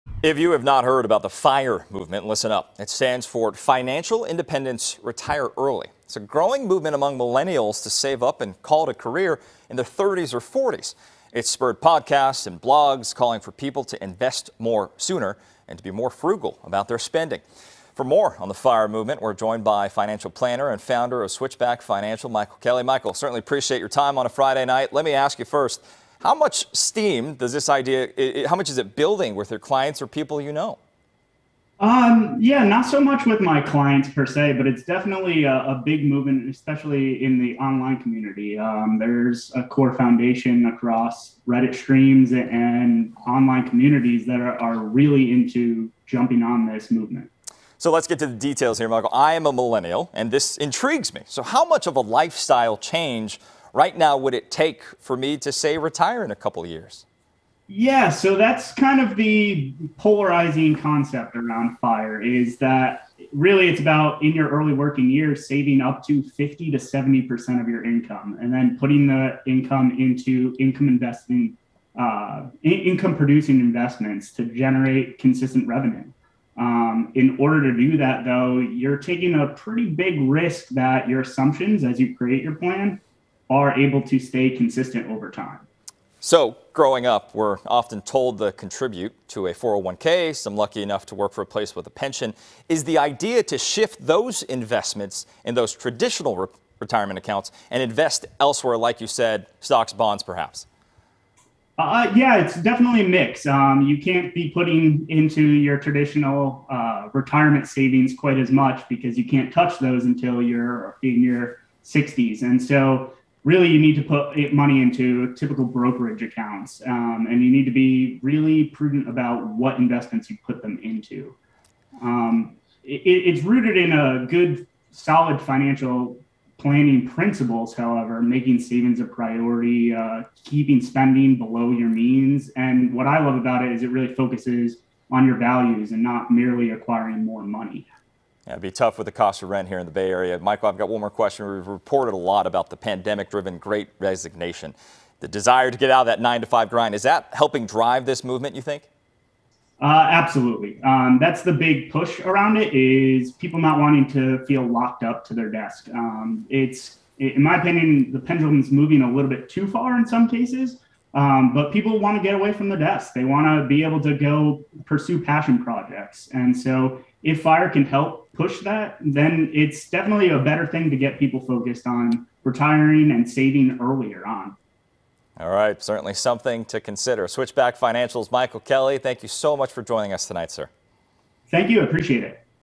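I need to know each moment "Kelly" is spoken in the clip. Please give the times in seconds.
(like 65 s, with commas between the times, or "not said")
22 s, 178 s.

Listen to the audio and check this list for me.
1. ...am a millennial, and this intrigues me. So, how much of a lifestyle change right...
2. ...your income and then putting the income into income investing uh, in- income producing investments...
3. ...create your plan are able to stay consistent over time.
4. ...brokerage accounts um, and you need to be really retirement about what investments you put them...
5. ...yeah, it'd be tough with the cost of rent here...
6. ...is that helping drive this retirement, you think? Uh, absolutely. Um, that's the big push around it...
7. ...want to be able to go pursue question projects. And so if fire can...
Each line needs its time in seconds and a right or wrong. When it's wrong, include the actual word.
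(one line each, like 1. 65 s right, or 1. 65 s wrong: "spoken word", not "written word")
1. 49 s right
2. 67 s right
3. 82 s right
4. 115 s wrong: "prudent", not "retirement"
5. 138 s right
6. 146 s wrong: "movement", not "retirement"
7. 163 s wrong: "passion", not "question".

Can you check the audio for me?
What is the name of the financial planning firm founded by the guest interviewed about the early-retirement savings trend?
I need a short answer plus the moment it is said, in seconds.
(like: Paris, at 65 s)
Switchback Financial, at 21 s.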